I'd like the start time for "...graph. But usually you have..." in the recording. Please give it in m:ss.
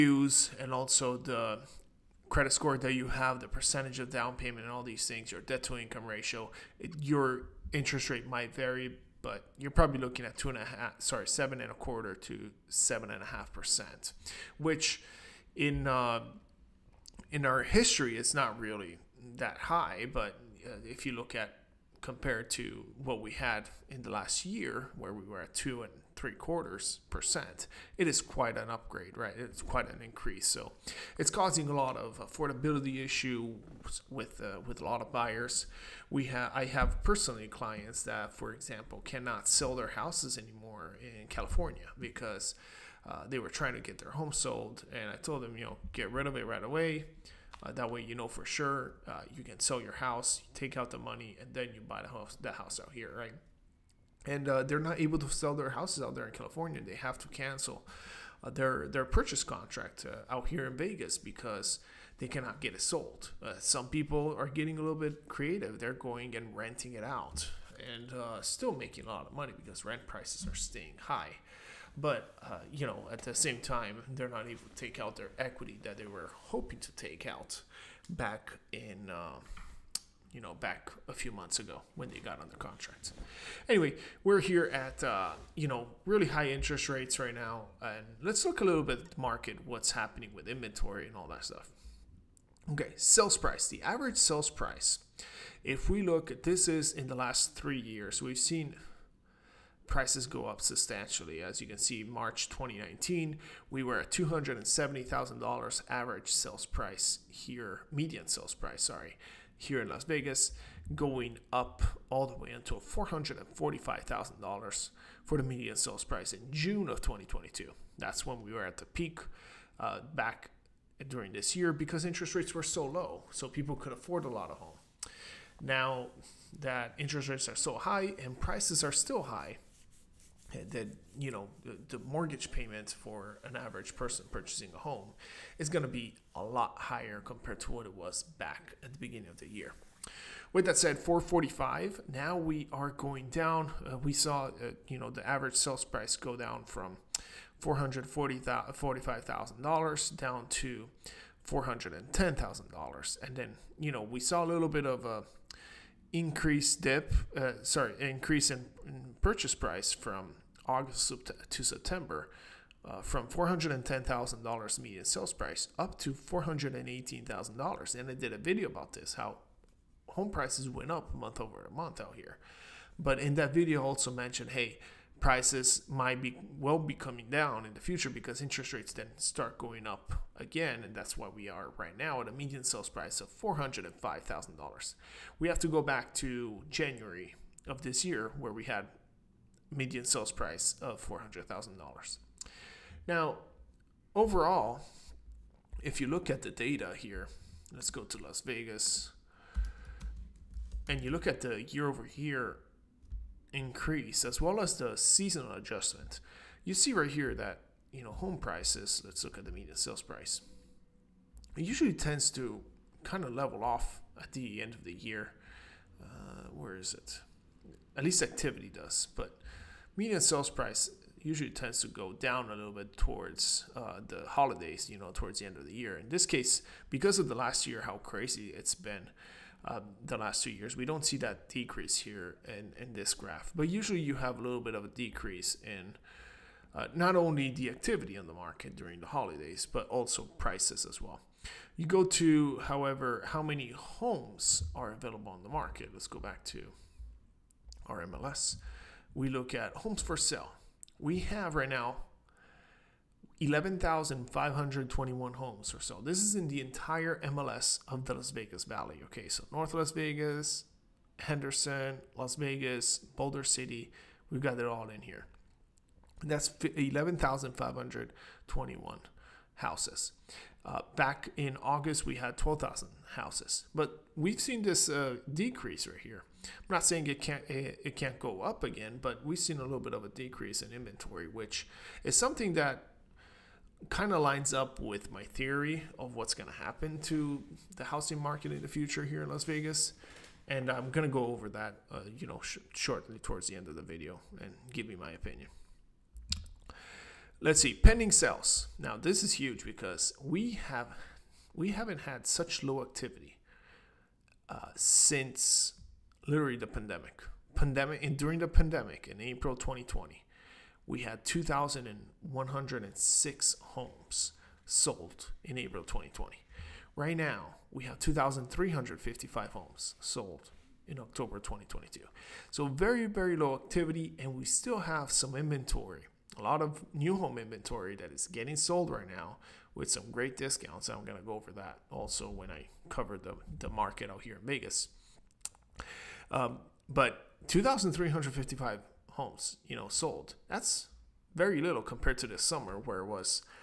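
3:53.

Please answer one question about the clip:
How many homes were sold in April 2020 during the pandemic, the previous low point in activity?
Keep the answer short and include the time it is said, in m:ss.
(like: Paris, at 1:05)
2,106, at 5:11.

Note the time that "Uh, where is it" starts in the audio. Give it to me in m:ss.
3:36.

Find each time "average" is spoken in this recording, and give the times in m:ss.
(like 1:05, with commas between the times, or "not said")
1:33, 1:45, 2:13, 2:25.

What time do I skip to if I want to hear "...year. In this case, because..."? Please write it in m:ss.
3:45.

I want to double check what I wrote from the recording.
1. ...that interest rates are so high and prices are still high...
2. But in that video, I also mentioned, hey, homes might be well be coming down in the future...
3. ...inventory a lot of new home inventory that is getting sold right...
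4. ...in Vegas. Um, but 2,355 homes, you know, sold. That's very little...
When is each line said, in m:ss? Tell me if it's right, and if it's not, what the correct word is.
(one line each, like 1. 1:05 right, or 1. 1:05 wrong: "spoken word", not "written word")
1. 2:06 right
2. 2:52 wrong: "prices", not "homes"
3. 5:25 right
4. 5:34 right.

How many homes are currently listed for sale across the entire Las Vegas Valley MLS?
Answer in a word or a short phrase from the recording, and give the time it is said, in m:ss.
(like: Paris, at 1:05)
11,521, at 4:13.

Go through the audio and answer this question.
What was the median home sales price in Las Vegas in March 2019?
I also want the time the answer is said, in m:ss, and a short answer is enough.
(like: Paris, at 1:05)
$270,000, at 1:44.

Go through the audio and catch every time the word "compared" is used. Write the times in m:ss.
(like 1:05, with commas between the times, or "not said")
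0:22, 2:17, 5:41.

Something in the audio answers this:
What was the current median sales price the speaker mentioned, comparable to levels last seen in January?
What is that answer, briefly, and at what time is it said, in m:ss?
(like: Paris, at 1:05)
$405,000, at 3:03.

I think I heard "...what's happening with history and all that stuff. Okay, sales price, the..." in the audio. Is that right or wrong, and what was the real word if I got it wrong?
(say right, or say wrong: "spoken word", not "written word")
wrong: "inventory", not "history".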